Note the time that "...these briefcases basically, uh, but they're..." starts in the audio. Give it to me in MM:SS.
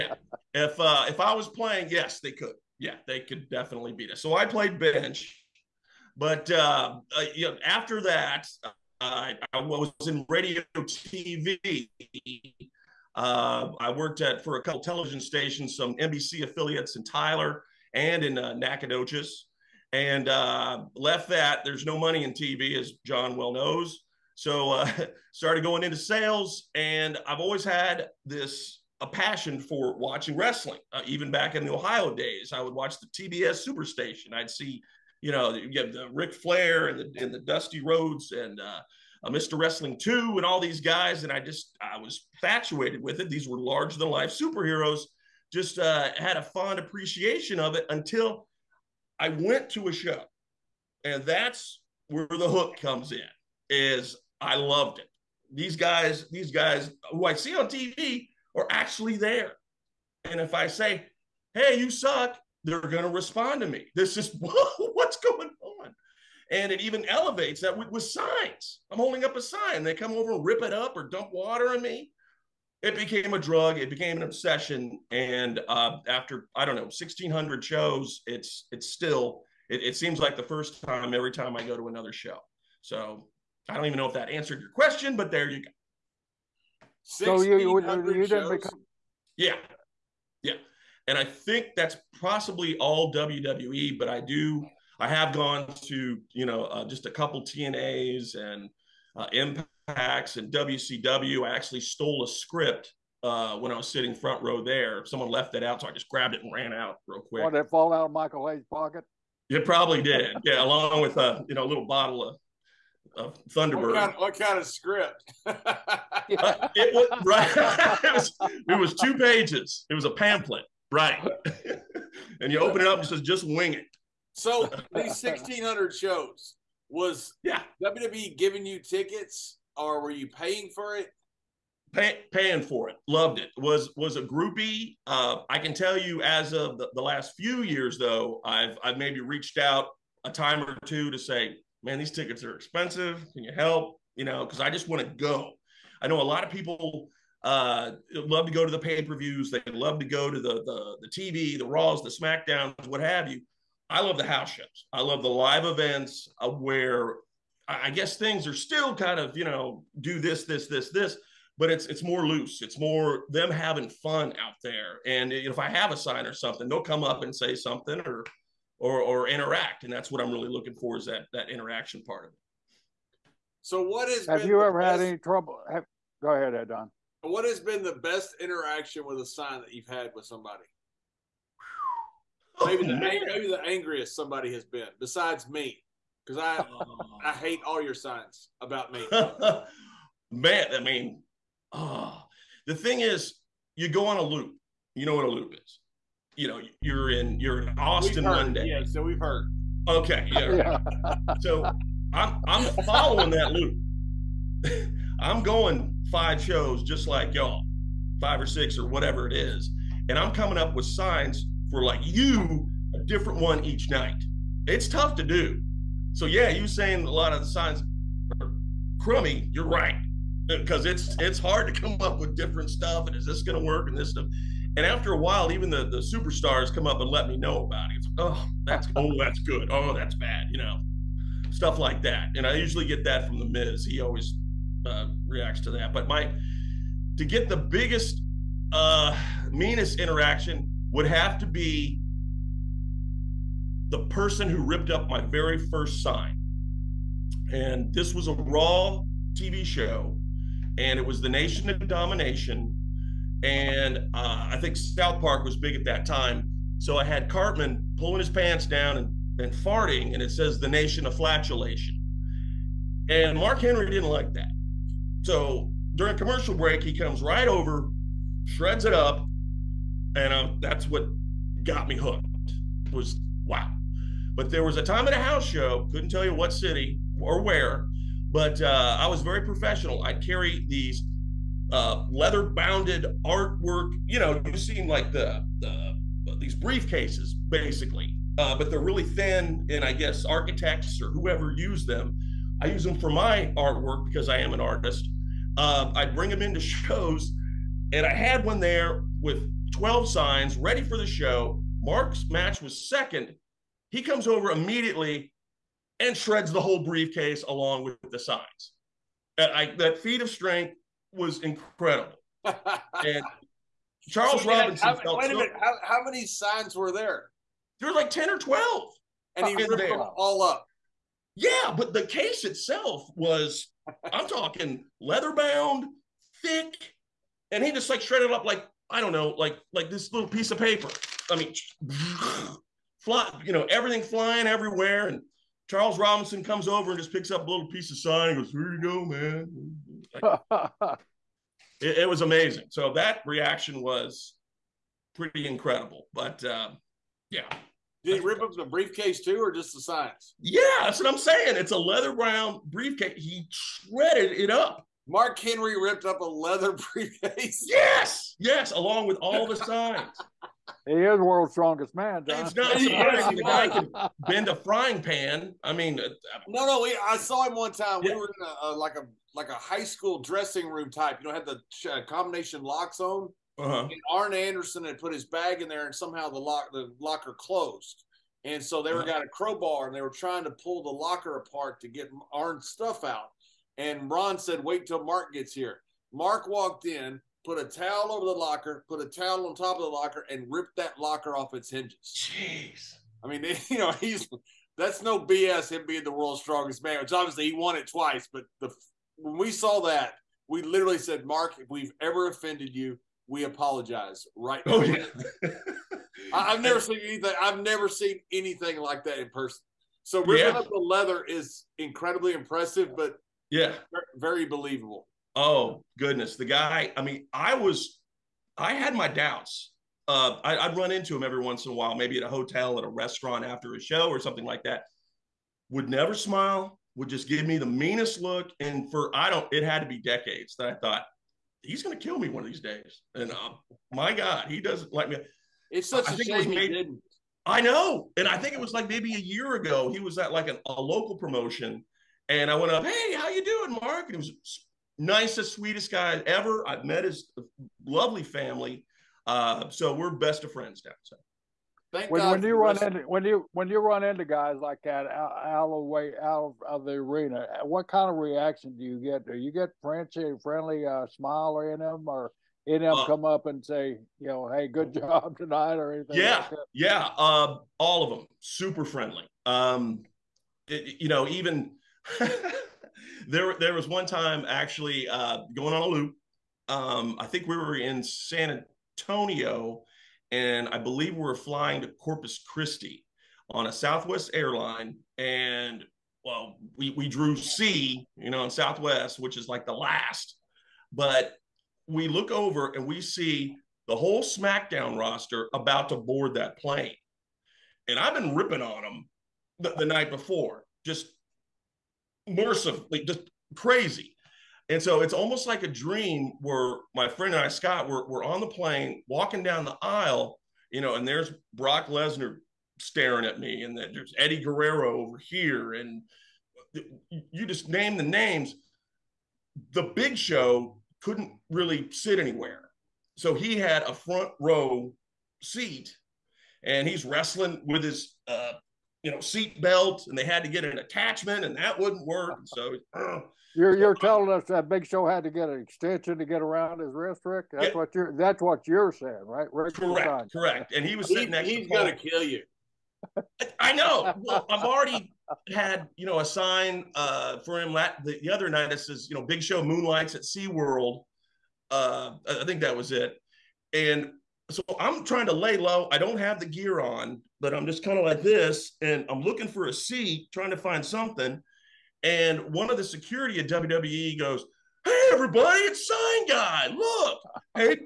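04:46.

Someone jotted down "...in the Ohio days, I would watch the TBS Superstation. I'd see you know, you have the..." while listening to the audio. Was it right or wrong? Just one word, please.
right.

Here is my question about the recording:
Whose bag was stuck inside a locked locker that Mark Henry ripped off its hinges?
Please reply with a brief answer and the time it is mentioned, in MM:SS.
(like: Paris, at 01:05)
Arn Anderson, at 06:14.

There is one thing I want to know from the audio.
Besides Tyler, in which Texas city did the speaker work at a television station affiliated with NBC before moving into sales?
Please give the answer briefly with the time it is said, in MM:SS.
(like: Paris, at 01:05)
Nacogdoches, at 00:18.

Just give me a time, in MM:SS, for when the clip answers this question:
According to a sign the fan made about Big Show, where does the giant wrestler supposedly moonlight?
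09:10.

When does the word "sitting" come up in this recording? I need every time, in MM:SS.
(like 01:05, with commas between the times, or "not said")
01:43, 09:01.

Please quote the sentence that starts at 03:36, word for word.
So yeah, you saying a lot of the signs are crummy, you're right.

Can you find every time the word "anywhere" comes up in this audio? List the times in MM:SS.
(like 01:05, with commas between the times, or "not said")
08:42.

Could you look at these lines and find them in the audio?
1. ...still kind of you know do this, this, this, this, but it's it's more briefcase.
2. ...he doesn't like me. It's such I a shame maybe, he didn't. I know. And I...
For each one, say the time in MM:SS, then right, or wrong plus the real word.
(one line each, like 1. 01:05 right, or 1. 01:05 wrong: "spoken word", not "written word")
1. 02:38 wrong: "loose", not "briefcase"
2. 07:14 right.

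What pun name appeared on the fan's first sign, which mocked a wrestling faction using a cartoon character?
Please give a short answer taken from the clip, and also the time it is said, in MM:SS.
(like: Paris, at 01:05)
Nation of Flatulation, at 04:20.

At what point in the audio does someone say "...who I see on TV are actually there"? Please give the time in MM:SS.
00:57.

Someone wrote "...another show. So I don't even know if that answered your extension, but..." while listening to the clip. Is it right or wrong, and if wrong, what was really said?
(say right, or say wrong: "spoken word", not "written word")
wrong: "question", not "extension".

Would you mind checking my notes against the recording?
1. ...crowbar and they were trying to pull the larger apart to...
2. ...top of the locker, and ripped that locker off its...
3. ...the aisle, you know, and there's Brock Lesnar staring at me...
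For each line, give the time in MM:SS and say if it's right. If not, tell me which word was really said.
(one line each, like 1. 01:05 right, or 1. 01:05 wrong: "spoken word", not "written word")
1. 06:19 wrong: "locker", not "larger"
2. 06:29 right
3. 08:29 right.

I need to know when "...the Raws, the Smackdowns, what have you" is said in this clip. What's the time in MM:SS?
02:31.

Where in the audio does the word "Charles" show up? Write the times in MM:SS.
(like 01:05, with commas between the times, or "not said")
05:14, 05:35.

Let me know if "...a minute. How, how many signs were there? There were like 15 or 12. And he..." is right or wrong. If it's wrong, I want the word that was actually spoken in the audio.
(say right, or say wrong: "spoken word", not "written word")
wrong: "10", not "15".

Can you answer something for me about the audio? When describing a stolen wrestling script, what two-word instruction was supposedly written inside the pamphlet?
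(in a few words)
Just wing it.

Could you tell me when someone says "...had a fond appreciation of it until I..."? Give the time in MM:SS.
00:46.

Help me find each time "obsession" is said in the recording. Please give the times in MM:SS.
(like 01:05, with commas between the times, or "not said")
01:14.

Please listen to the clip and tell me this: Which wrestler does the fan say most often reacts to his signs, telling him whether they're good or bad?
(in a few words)
The Miz.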